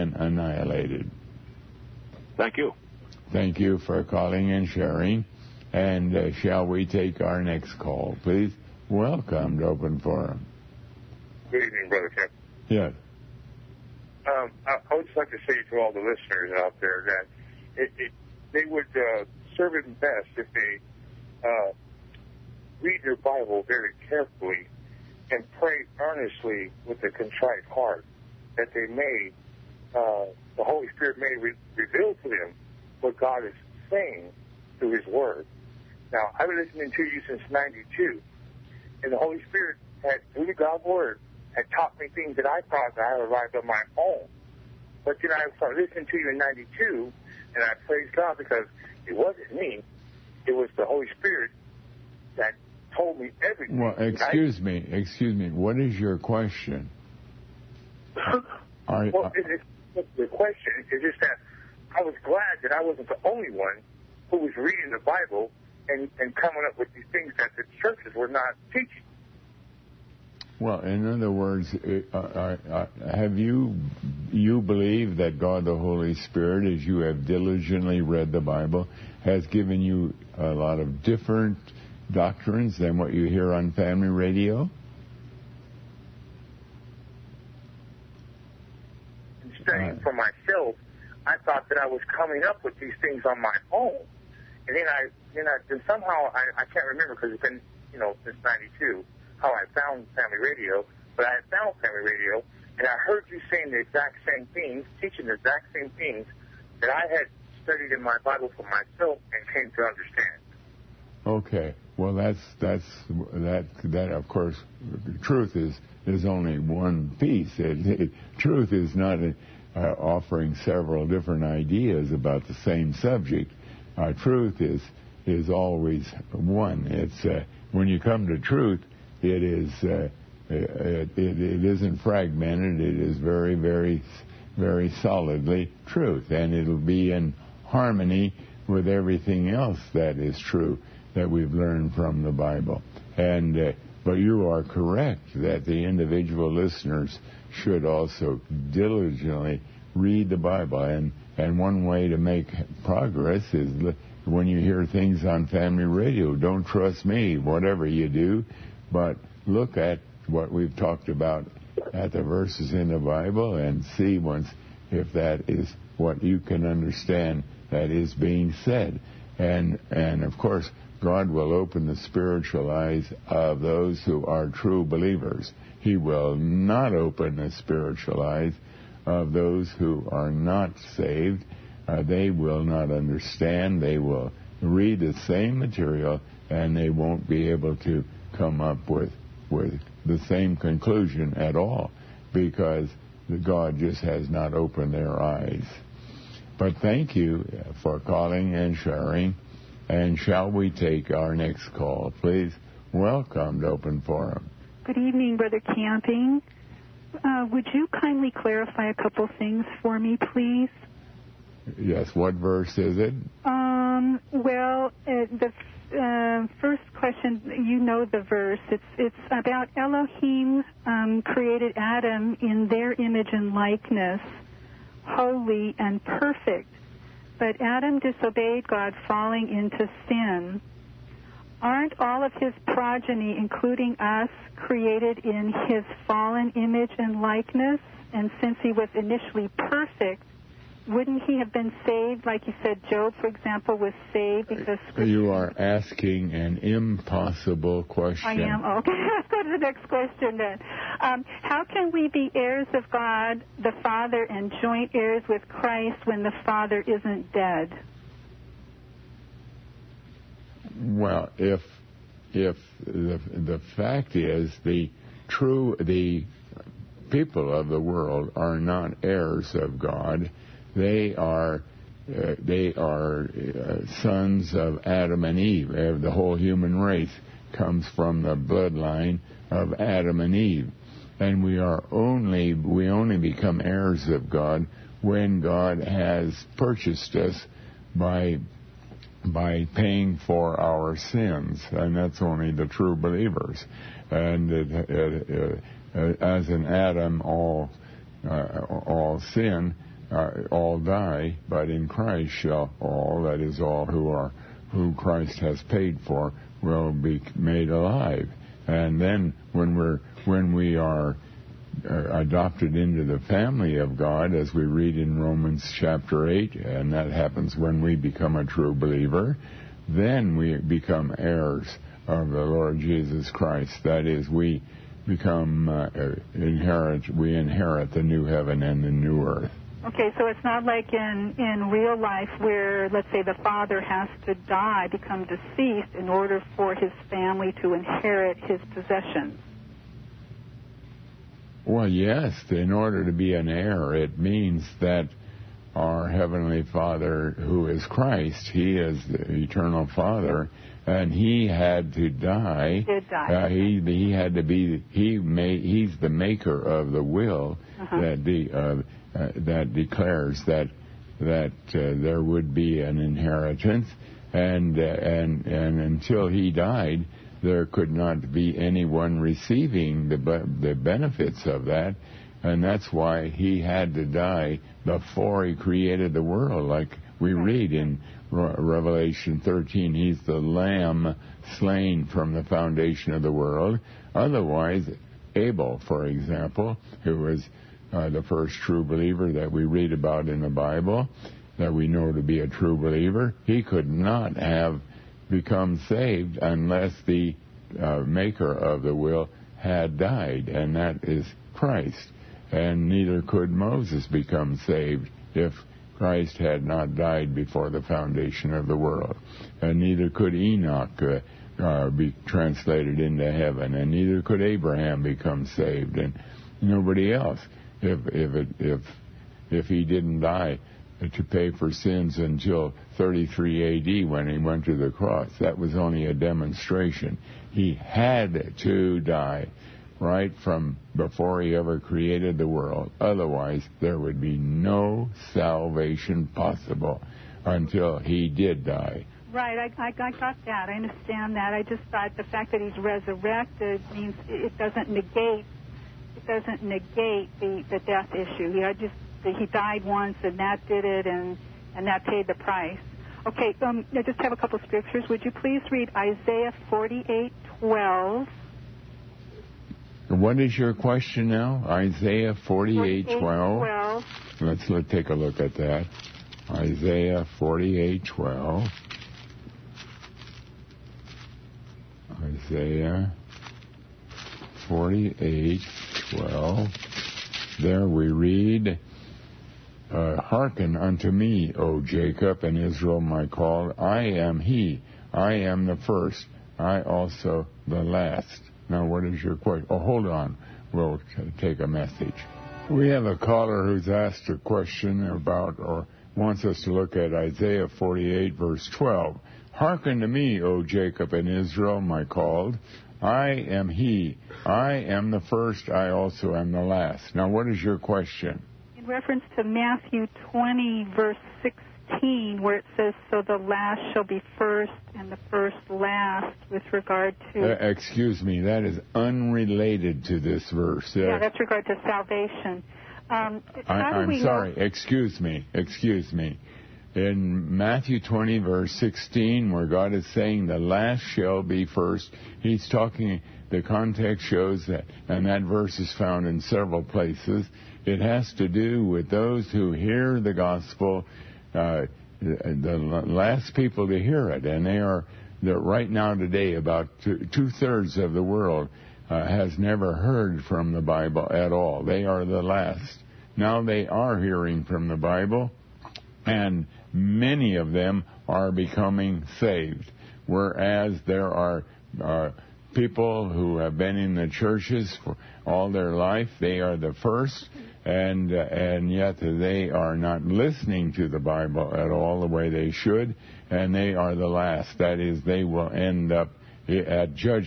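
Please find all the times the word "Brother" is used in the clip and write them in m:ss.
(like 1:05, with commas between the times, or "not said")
0:11, 3:25.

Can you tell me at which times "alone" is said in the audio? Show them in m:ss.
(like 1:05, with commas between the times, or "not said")
not said.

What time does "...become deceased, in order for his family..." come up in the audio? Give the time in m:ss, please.
5:34.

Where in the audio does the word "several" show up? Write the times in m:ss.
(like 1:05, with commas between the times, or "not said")
2:00, 8:56.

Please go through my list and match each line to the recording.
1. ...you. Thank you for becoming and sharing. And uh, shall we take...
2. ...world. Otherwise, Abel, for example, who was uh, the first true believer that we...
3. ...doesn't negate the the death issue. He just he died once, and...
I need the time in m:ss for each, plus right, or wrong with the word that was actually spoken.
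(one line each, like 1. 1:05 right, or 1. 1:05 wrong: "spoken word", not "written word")
1. 0:02 wrong: "calling", not "becoming"
2. 6:23 right
3. 7:26 right.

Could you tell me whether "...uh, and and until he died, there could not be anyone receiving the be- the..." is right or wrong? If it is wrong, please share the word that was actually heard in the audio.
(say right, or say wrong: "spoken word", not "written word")
right.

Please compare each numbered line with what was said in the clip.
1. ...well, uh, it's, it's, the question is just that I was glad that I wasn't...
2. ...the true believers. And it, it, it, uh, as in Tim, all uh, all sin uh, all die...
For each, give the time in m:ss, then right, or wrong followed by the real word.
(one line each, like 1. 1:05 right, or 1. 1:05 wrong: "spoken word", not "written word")
1. 0:59 right
2. 4:52 wrong: "Adam", not "Tim".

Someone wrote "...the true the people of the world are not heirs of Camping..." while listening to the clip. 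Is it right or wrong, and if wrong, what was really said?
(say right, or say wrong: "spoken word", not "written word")
wrong: "God", not "Camping".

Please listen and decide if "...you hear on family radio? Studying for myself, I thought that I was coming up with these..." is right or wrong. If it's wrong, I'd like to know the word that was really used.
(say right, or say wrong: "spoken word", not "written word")
right.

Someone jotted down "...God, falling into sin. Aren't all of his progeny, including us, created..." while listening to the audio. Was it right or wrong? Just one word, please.
right.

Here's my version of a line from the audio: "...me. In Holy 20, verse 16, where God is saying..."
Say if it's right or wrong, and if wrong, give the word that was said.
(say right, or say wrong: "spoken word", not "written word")
wrong: "Matthew", not "Holy".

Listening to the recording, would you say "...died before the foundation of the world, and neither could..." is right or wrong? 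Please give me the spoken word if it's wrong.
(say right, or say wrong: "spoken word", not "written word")
right.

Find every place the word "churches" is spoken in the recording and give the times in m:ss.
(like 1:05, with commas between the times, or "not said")
1:07, 9:24.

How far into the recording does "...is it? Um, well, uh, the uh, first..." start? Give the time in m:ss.
3:32.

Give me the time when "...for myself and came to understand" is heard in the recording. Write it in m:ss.
1:48.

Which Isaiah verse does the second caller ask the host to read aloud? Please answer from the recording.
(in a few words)
Isaiah 48:12.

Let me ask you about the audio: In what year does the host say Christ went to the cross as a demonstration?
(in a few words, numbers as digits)
33 AD.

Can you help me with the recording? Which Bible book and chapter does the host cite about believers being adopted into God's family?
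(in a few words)
Romans 8.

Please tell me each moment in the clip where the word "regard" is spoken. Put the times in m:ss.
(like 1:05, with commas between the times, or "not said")
8:36, 8:41.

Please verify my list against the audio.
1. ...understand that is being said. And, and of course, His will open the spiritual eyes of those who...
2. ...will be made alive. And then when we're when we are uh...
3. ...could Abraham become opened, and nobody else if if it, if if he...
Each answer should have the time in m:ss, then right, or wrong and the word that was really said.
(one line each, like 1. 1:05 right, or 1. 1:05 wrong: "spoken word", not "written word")
1. 2:46 wrong: "God", not "His"
2. 5:06 right
3. 6:54 wrong: "saved", not "opened".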